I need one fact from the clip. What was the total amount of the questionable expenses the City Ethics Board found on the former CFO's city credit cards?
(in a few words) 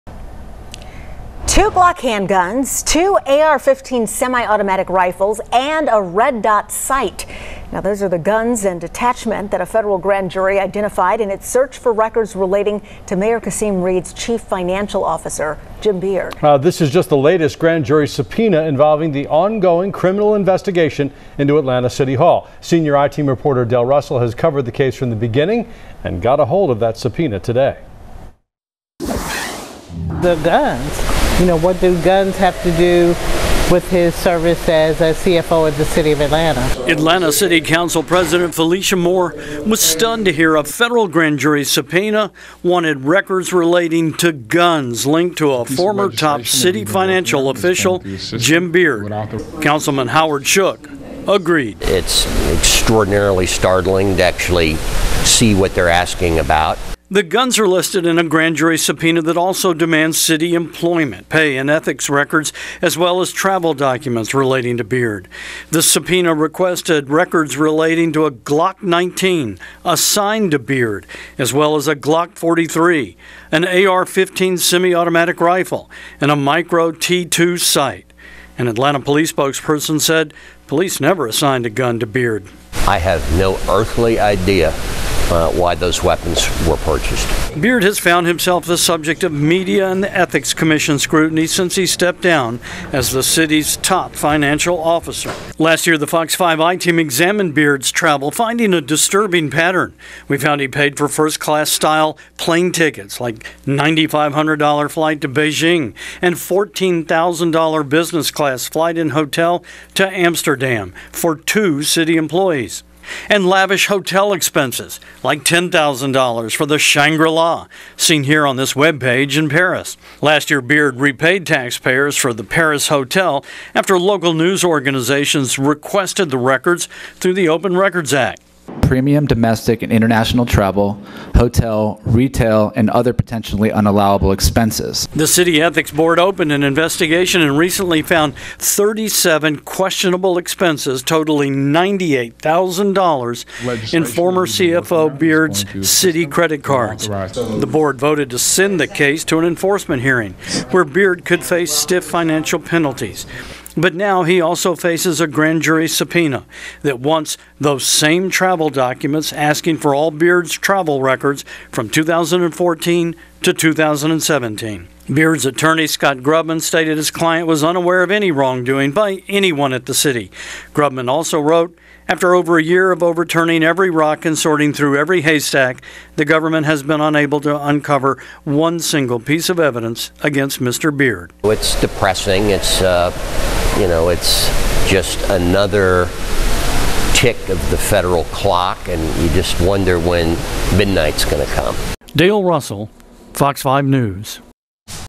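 $98,000.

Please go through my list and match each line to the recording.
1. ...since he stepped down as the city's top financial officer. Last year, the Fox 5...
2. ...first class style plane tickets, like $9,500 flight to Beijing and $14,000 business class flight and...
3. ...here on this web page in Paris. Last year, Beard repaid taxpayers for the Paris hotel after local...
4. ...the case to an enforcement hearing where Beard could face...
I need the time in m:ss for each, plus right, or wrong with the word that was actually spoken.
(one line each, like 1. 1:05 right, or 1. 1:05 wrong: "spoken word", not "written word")
1. 1:31 right
2. 1:41 right
3. 1:58 right
4. 2:28 right.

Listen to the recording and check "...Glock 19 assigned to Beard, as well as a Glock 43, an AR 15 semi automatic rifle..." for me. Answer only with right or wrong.
right.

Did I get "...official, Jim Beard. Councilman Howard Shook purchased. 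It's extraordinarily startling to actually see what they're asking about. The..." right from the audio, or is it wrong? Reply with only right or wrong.
wrong.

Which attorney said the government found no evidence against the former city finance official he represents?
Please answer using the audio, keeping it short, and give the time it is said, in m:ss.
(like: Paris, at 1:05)
Scott Grubman, at 2:45.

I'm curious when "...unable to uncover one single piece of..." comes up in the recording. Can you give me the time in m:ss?
2:56.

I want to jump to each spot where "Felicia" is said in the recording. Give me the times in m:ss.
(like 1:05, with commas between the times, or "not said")
0:38.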